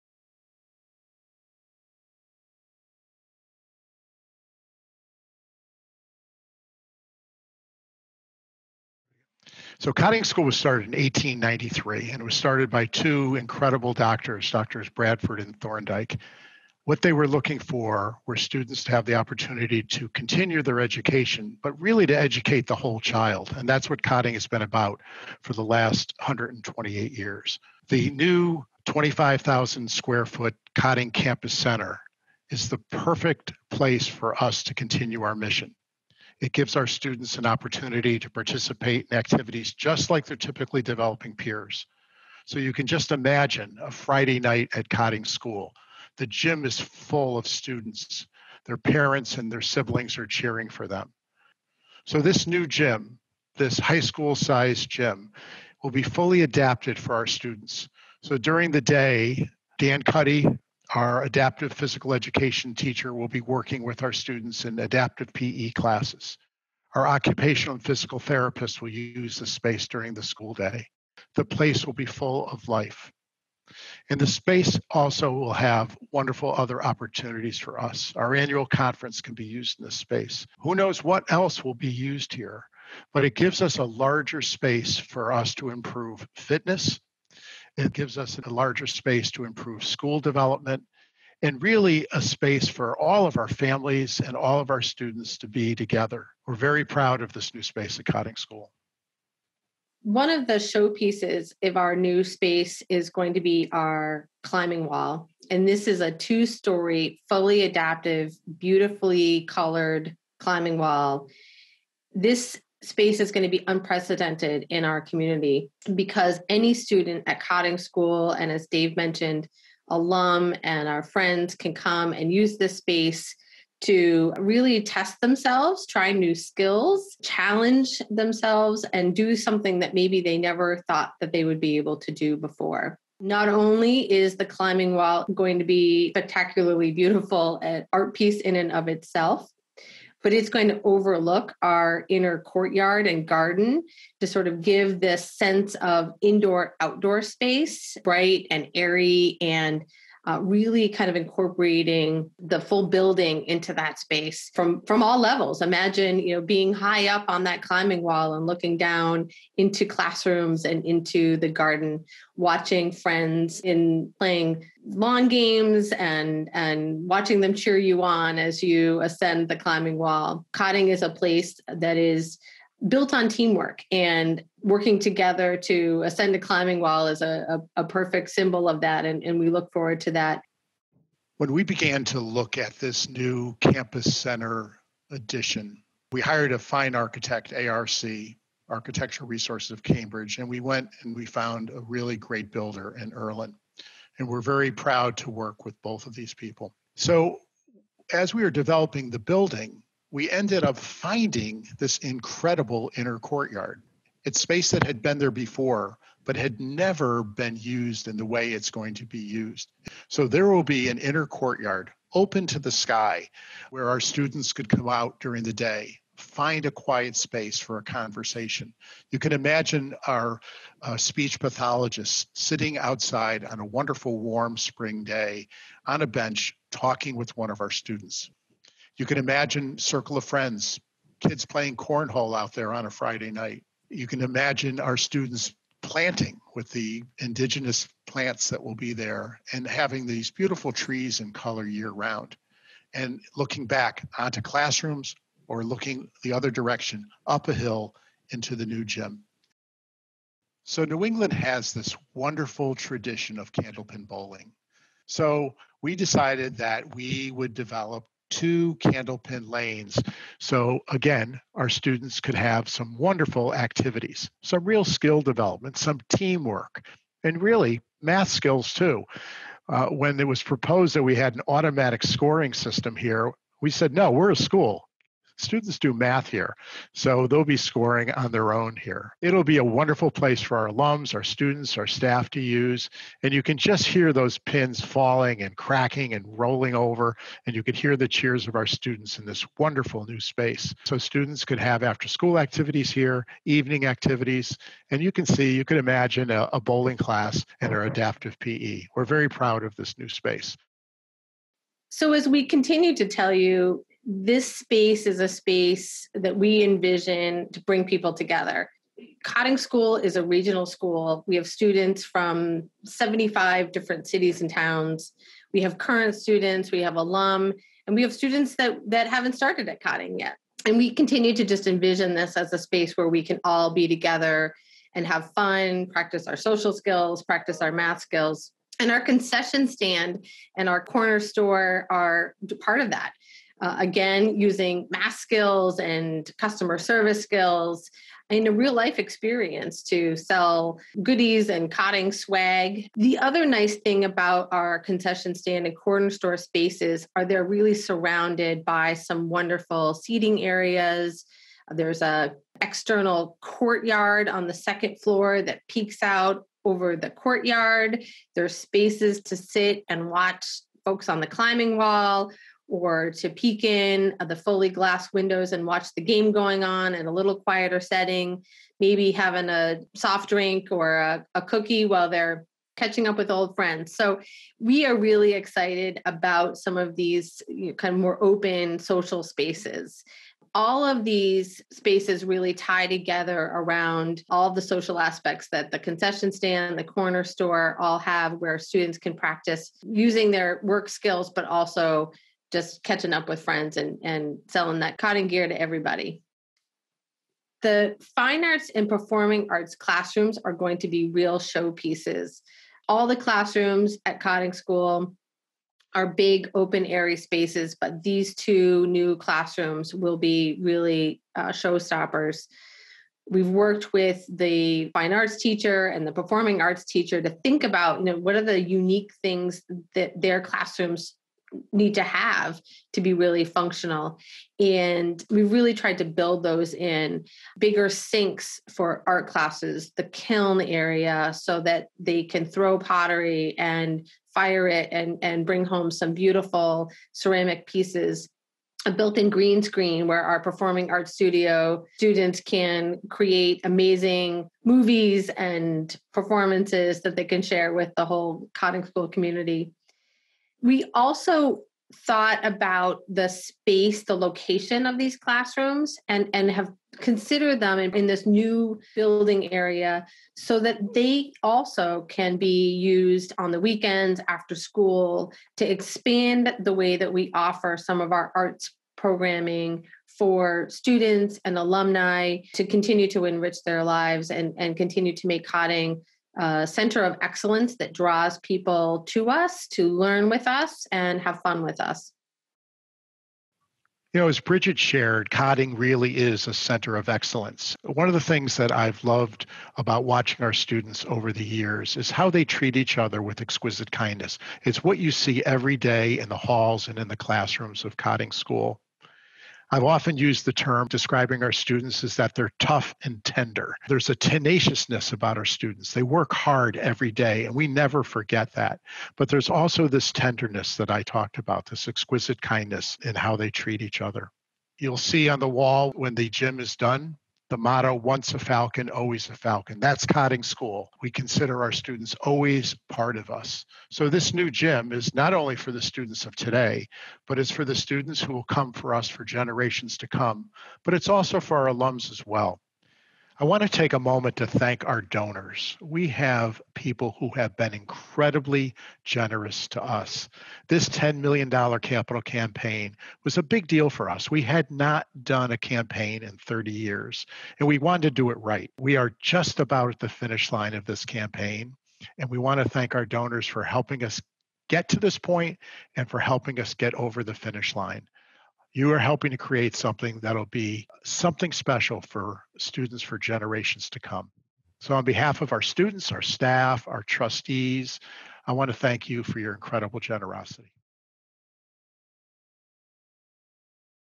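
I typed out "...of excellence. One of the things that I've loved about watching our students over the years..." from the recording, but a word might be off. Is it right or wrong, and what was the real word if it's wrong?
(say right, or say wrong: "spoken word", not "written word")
right.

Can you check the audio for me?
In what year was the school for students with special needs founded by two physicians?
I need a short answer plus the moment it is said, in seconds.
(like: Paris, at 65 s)
1893, at 11 s.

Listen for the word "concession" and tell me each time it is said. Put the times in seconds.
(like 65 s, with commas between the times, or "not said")
329 s, 344 s, 385 s.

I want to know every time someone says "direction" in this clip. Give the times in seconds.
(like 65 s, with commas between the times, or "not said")
246 s.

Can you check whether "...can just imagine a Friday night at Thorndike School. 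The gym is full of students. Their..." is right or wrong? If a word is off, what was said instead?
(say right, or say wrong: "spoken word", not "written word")
wrong: "Cotting", not "Thorndike".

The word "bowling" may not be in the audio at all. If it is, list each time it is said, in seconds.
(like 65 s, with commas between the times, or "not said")
254 s, 296 s.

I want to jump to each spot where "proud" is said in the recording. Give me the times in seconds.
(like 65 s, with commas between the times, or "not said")
96 s, 194 s, 299 s.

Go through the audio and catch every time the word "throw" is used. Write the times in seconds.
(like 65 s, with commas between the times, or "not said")
432 s.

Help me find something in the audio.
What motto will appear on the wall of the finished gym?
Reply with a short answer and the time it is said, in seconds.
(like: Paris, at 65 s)
Once a falcon always a falcon, at 517 s.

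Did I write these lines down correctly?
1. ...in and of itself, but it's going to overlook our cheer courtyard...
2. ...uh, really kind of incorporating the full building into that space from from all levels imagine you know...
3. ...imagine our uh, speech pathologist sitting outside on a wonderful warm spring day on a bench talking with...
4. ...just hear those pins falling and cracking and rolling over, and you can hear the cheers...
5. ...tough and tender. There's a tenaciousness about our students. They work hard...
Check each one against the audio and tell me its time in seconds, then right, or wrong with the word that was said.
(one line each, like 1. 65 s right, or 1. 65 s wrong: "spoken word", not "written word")
1. 138 s wrong: "inner", not "cheer"
2. 150 s right
3. 219 s right
4. 283 s right
5. 502 s right.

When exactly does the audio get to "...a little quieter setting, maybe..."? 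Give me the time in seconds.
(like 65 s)
367 s.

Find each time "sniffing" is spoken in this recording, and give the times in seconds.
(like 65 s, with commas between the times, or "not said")
not said.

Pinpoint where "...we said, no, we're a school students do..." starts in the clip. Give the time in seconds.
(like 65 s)
273 s.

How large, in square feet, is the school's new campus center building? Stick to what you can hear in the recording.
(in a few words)
25,000.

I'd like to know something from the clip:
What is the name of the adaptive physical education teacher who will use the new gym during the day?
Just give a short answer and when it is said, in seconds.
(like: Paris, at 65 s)
Dan Cuddy, at 59 s.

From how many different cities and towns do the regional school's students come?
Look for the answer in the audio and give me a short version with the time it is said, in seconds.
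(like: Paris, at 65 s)
75, at 312 s.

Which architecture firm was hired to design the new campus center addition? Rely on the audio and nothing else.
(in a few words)
Architectural Resources of Cambridge.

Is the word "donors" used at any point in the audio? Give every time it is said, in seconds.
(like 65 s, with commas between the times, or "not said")
535 s, 553 s.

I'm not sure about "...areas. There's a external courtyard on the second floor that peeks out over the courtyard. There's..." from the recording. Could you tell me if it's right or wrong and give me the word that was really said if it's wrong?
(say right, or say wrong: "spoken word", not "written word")
right.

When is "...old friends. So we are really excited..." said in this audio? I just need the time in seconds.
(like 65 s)
373 s.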